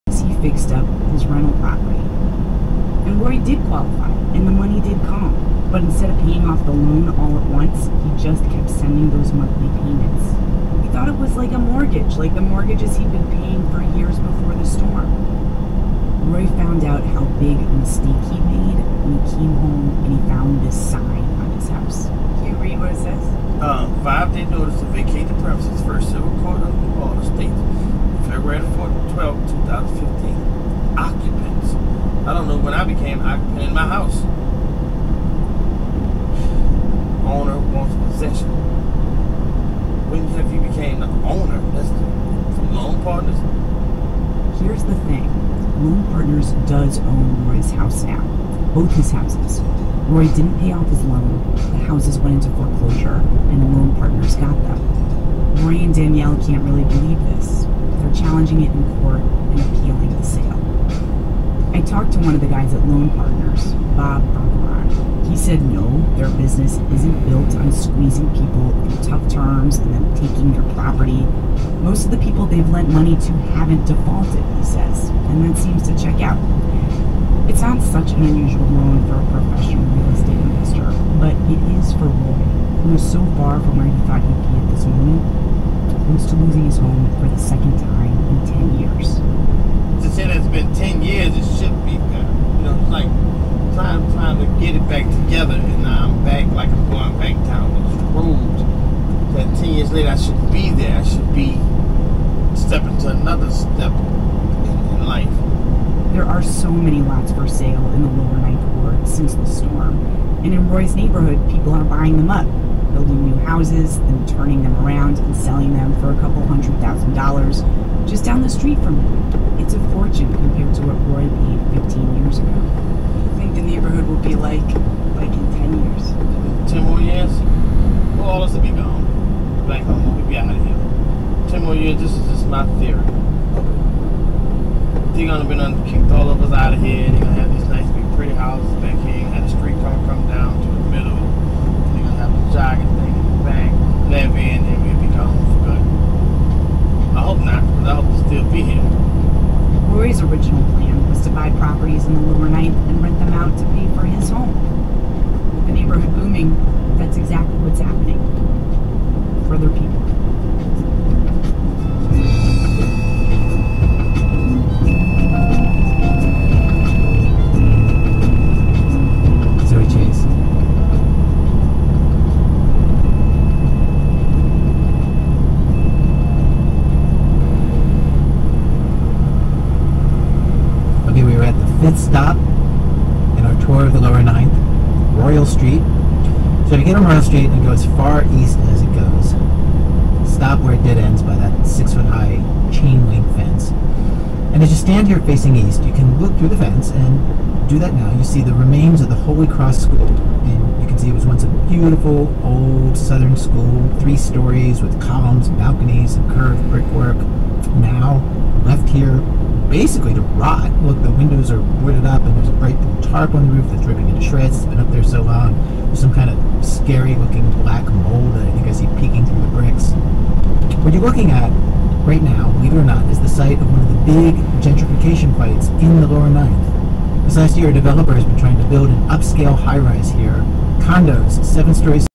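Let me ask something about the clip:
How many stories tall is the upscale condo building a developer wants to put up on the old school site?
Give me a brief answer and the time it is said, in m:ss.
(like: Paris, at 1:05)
7, at 3:51.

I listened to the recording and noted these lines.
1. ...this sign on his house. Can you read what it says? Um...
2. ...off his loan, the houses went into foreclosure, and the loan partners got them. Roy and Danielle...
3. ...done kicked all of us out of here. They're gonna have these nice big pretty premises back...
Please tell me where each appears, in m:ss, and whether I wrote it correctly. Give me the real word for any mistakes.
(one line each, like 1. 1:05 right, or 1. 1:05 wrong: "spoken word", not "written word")
1. 0:20 right
2. 0:50 right
3. 2:15 wrong: "houses", not "premises".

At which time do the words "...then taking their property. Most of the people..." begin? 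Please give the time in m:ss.
1:09.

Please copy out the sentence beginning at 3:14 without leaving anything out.
And as you stand here facing east, you can look through the fence and do that now.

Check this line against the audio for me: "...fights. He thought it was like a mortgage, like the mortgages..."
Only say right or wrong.
wrong.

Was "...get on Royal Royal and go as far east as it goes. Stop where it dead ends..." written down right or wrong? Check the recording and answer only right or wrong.
wrong.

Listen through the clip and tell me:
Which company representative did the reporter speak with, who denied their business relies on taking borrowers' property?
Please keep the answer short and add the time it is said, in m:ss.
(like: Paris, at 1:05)
Bob Bergeron, at 1:03.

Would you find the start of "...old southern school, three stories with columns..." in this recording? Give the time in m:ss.
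3:22.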